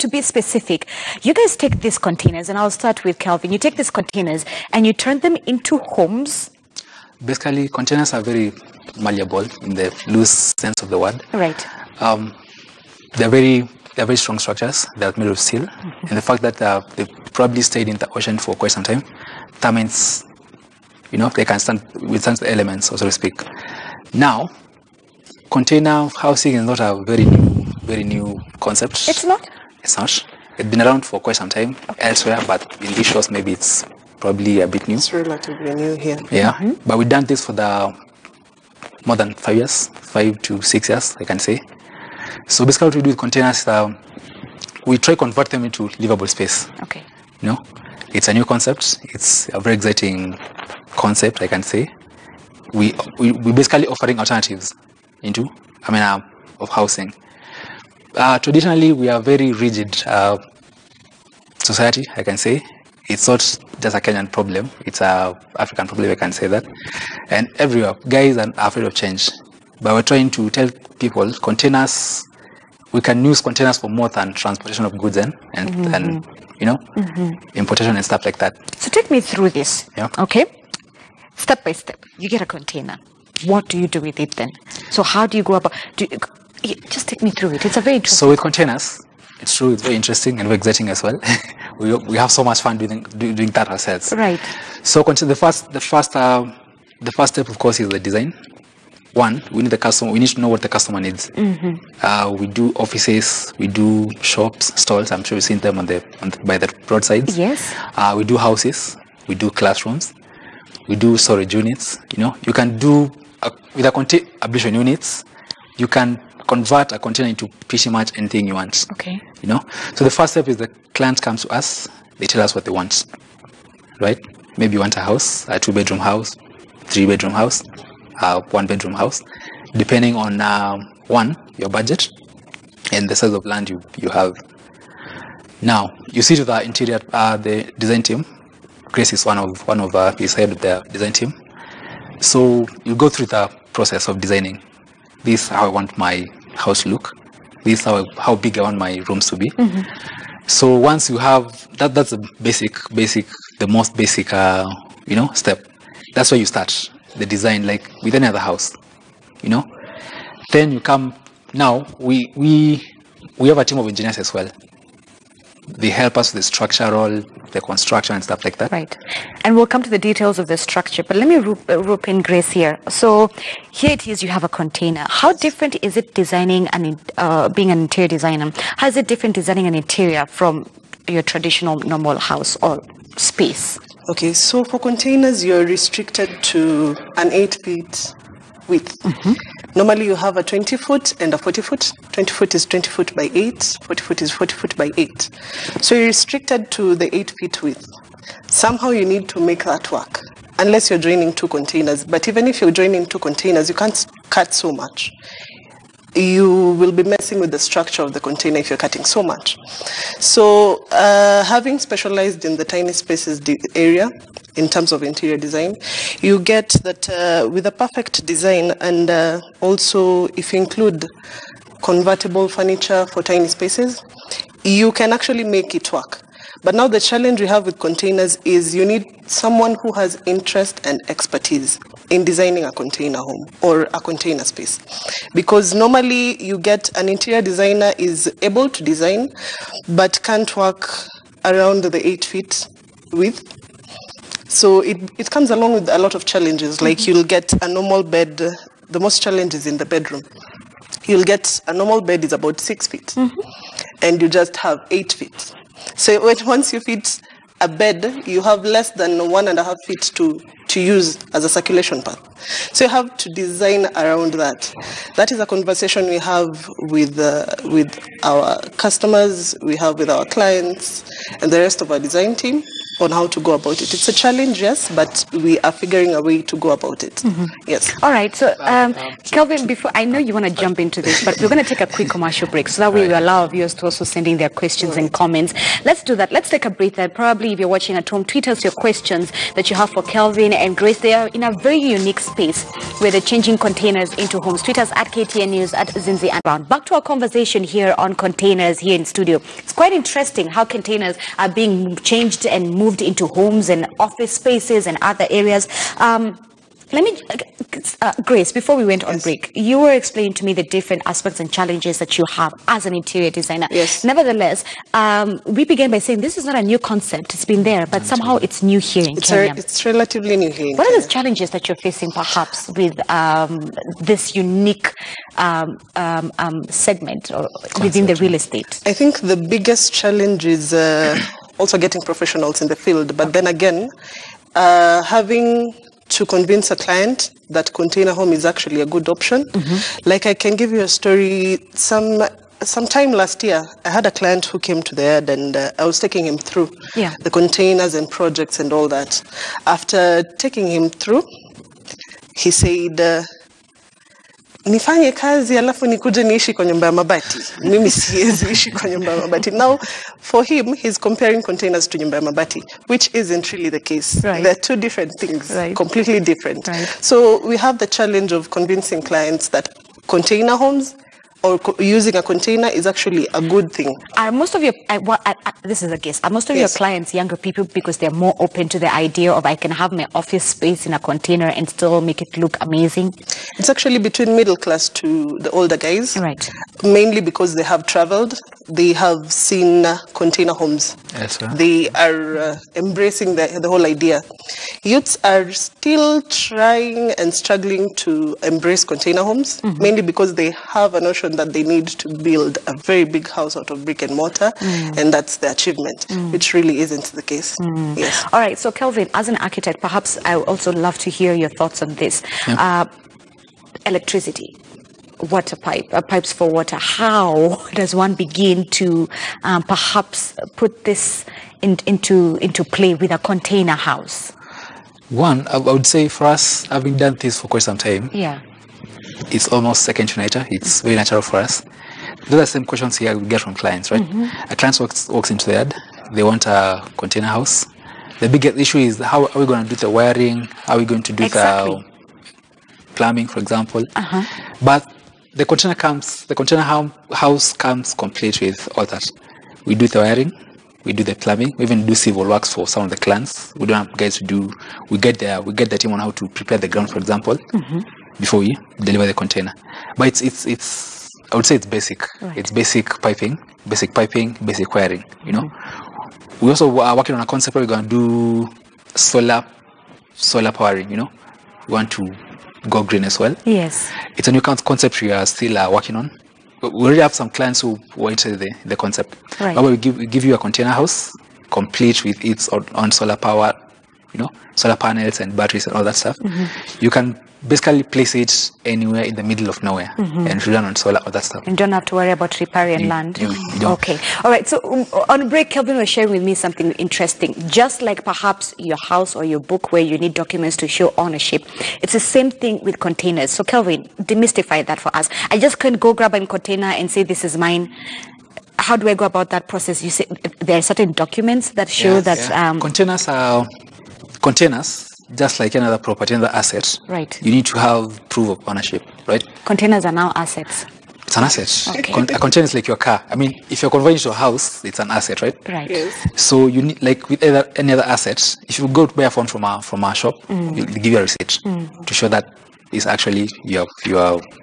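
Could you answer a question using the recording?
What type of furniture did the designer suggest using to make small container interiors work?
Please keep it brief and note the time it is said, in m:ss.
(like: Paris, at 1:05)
Convertible furniture, at 3:41.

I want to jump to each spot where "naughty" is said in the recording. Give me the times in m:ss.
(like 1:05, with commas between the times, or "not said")
not said.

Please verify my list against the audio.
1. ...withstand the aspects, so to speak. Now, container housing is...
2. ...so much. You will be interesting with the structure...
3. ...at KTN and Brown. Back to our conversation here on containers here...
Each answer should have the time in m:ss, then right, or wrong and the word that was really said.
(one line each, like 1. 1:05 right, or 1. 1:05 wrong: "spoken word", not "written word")
1. 0:22 wrong: "elements", not "aspects"
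2. 3:24 wrong: "messing", not "interesting"
3. 4:55 wrong: "Zinzi", not "KTN".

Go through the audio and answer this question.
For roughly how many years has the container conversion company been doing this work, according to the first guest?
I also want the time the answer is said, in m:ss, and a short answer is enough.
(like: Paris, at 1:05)
5 to 6 years, at 0:40.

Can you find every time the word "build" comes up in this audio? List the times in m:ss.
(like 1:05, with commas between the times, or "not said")
6:42.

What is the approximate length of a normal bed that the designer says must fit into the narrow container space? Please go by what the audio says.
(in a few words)
6 feet.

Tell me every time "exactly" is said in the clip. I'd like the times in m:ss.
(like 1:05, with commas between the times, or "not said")
7:21.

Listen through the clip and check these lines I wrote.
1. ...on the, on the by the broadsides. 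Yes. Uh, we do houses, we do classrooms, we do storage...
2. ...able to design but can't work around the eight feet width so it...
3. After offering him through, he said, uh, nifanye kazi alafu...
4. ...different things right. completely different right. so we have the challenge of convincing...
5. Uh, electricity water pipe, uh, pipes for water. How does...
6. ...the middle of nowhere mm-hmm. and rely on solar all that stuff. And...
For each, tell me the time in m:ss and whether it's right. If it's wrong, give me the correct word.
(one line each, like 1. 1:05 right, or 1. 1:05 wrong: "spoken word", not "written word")
1. 1:45 right
2. 3:58 right
3. 5:49 wrong: "taking", not "offering"
4. 6:04 right
5. 6:52 right
6. 8:09 right.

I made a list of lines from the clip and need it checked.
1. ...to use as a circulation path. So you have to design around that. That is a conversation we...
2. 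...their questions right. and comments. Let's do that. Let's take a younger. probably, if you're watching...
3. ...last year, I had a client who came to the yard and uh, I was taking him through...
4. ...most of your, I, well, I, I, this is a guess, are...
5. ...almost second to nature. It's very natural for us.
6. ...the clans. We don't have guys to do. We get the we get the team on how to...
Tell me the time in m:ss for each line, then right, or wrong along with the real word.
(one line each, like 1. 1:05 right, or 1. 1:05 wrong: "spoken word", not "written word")
1. 4:20 right
2. 4:44 wrong: "breather", not "younger"
3. 5:43 right
4. 6:14 right
5. 7:09 right
6. 7:32 right.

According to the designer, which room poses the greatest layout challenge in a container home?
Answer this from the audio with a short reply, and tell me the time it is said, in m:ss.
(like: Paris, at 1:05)
The bedroom, at 4:09.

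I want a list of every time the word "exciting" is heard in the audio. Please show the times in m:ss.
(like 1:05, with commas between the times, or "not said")
0:49, 1:30.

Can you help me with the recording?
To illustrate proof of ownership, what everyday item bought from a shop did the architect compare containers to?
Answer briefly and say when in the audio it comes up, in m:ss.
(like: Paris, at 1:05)
A phone, at 8:49.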